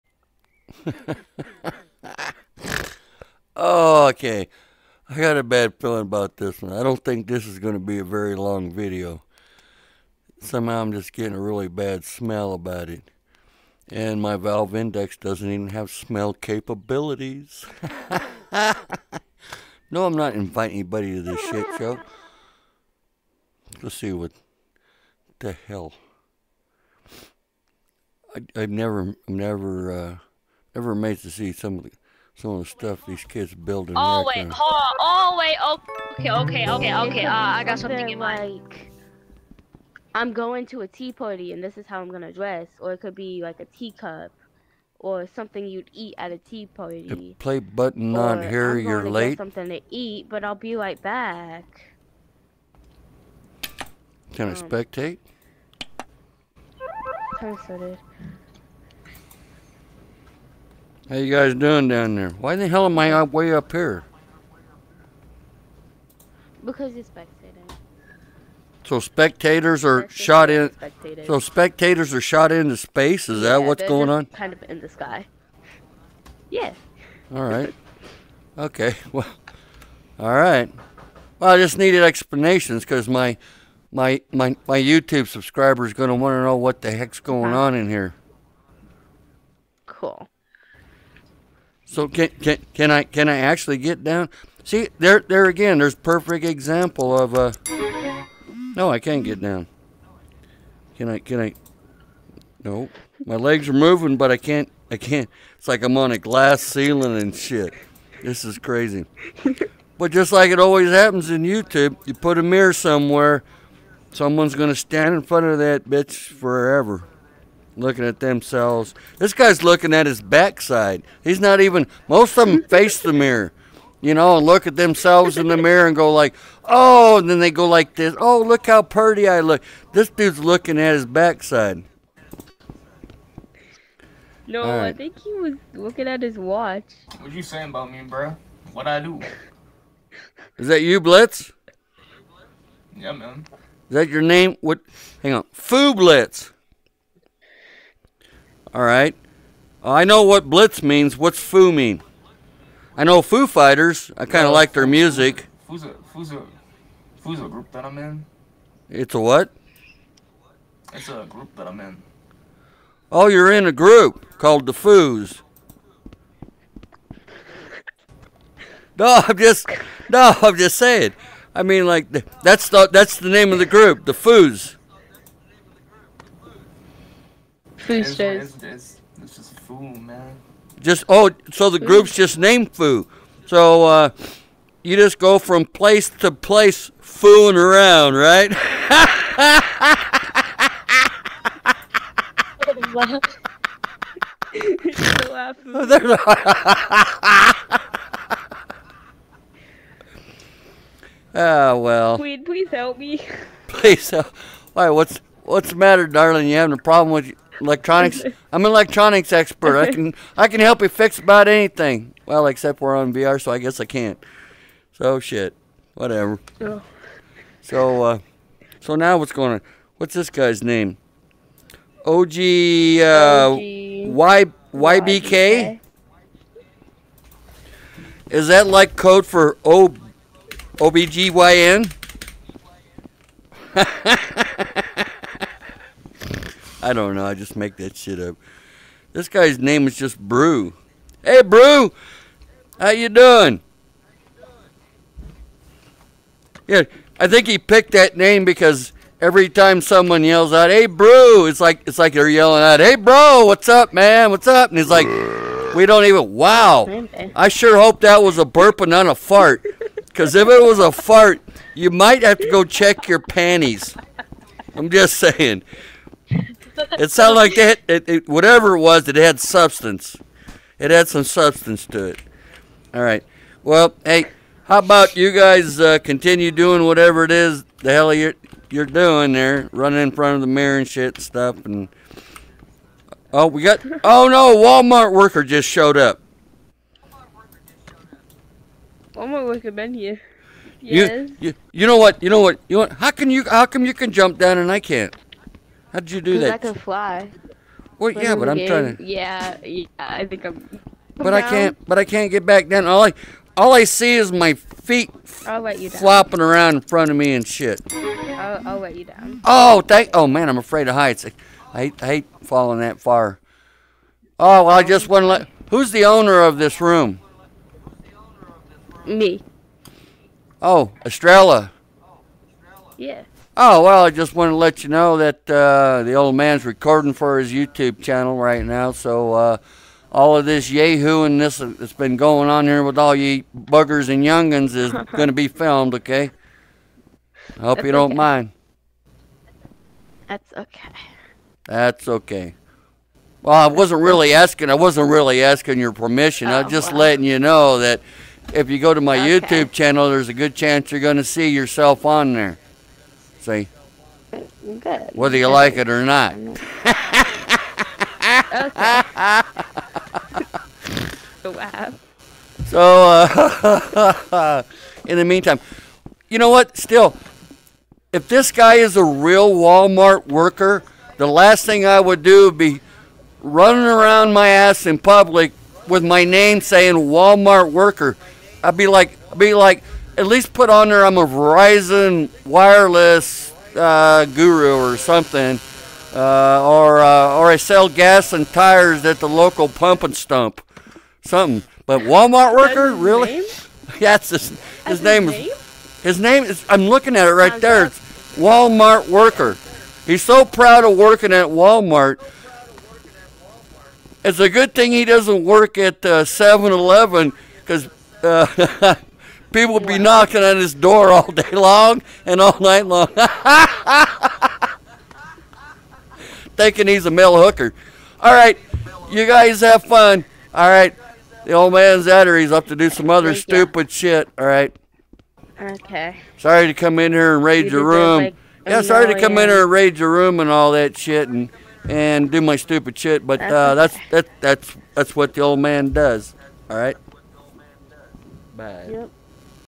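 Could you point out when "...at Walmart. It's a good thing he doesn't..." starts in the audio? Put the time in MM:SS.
06:41.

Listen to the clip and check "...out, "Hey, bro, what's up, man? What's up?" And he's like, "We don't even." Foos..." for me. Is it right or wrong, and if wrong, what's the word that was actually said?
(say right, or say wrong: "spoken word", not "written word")
wrong: "Wow", not "Foos".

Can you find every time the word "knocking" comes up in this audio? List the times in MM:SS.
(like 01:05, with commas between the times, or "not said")
06:49.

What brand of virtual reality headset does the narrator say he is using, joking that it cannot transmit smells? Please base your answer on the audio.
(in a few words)
Valve Index.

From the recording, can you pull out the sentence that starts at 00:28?
I, have never, never, uh, ever amazed to see some of the some of the stuff these kids building.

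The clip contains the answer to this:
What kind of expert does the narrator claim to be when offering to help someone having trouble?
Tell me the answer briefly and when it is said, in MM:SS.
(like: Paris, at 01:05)
Electronics expert, at 03:28.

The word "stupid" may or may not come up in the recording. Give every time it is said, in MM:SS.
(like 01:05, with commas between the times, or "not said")
07:03, 07:12.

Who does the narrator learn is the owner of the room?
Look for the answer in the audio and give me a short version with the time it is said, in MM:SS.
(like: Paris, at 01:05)
Estrella, at 05:21.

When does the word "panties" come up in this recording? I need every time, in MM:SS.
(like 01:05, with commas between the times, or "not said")
04:23.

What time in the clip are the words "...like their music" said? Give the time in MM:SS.
02:34.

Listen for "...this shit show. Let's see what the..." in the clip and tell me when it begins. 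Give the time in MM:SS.
00:21.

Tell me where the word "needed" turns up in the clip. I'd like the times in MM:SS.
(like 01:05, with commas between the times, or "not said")
01:21.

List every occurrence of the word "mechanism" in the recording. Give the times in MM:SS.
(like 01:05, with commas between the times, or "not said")
not said.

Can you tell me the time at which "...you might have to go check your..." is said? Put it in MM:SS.
04:21.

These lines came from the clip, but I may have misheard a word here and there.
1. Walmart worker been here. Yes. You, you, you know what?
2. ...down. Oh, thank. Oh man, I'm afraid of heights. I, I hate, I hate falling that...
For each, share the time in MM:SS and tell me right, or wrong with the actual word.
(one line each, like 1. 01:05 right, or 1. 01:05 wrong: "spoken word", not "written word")
1. 04:49 right
2. 05:09 right.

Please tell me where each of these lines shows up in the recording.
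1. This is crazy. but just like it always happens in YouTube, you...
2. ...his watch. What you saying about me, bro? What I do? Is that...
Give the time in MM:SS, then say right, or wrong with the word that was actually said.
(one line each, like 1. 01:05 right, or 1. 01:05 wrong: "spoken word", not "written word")
1. 01:48 right
2. 02:16 right.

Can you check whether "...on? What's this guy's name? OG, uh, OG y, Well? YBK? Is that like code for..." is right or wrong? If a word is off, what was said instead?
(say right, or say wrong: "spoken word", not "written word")
wrong: "YBK", not "Well".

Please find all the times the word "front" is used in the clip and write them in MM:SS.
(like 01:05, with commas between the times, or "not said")
01:55, 04:40, 05:06.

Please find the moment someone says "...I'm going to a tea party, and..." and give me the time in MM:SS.
00:40.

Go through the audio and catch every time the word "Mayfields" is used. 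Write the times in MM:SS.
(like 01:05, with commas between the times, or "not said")
not said.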